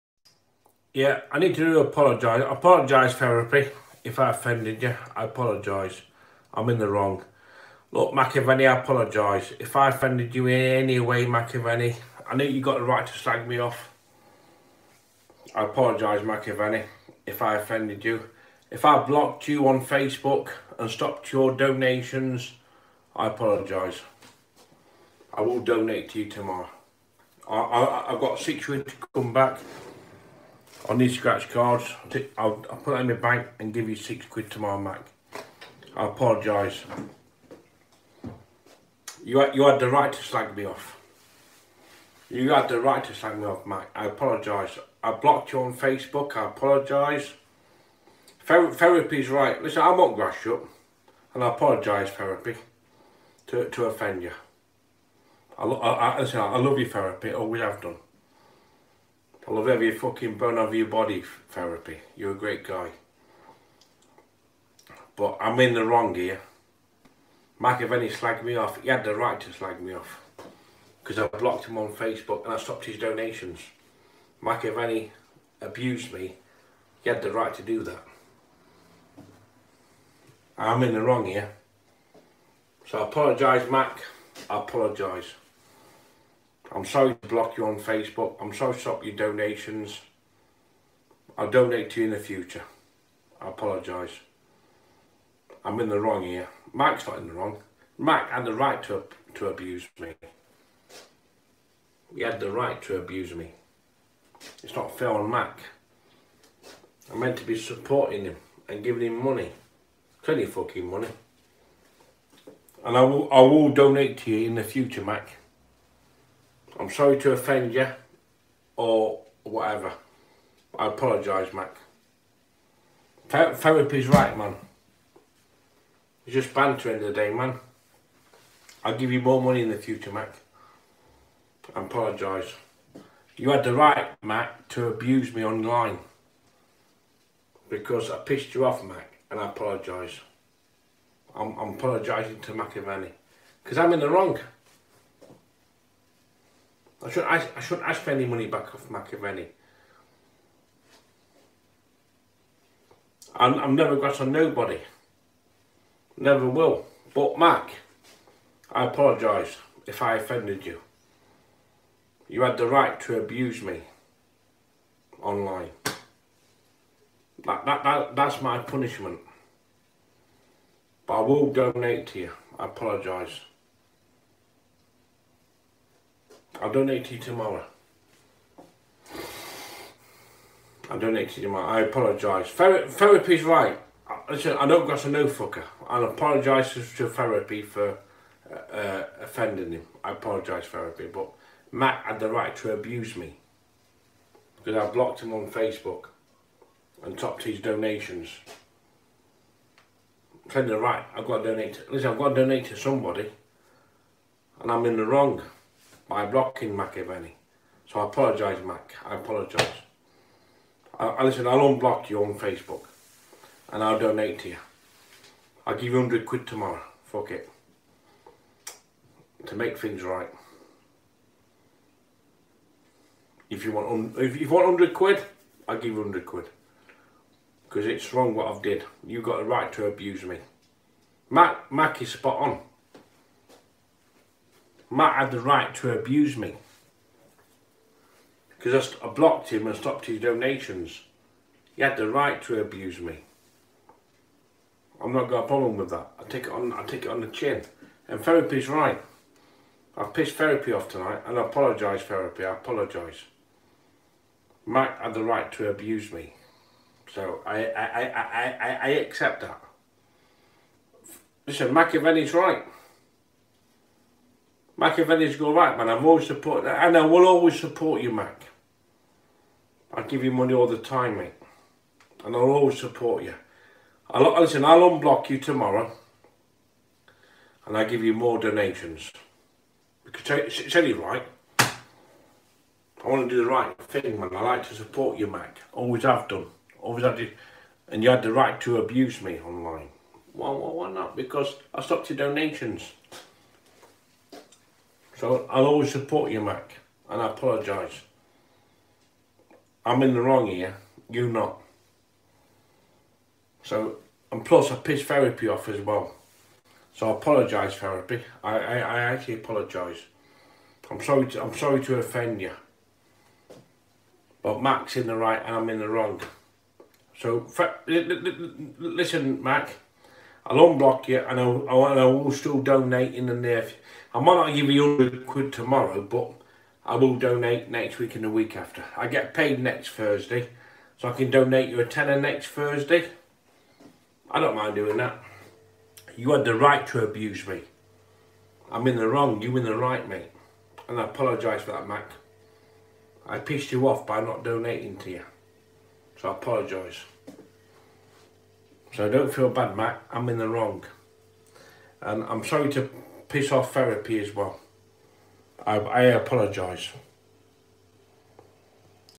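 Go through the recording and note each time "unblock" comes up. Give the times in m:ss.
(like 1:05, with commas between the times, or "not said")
3:31, 4:34, 5:20.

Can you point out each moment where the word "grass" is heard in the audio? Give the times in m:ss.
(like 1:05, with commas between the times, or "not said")
0:50, 2:33.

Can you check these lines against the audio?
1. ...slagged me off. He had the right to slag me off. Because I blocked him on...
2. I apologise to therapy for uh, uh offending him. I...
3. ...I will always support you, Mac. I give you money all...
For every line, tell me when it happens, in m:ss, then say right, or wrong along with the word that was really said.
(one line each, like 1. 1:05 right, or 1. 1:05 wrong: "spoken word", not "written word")
1. 1:08 right
2. 3:05 right
3. 4:26 right.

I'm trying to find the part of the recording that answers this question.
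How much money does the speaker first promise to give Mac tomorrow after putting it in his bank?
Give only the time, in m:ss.
0:33.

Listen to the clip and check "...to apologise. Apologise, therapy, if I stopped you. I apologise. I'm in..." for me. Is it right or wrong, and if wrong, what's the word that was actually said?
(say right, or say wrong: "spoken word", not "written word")
wrong: "offended", not "stopped".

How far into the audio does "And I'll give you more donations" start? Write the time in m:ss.
4:37.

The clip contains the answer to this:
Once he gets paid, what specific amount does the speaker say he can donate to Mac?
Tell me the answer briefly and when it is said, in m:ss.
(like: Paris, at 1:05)
a tenner, at 5:31.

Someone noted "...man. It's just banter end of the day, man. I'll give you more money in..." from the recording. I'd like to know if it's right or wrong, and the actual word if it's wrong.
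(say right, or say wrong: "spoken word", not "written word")
right.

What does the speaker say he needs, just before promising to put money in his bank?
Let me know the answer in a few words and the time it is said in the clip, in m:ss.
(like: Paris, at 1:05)
scratch cards, at 0:31.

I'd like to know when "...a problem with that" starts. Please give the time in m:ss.
4:05.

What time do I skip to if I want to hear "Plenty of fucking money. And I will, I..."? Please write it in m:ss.
1:50.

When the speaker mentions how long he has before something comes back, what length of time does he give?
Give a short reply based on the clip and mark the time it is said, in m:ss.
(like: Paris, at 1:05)
6 weeks, at 0:28.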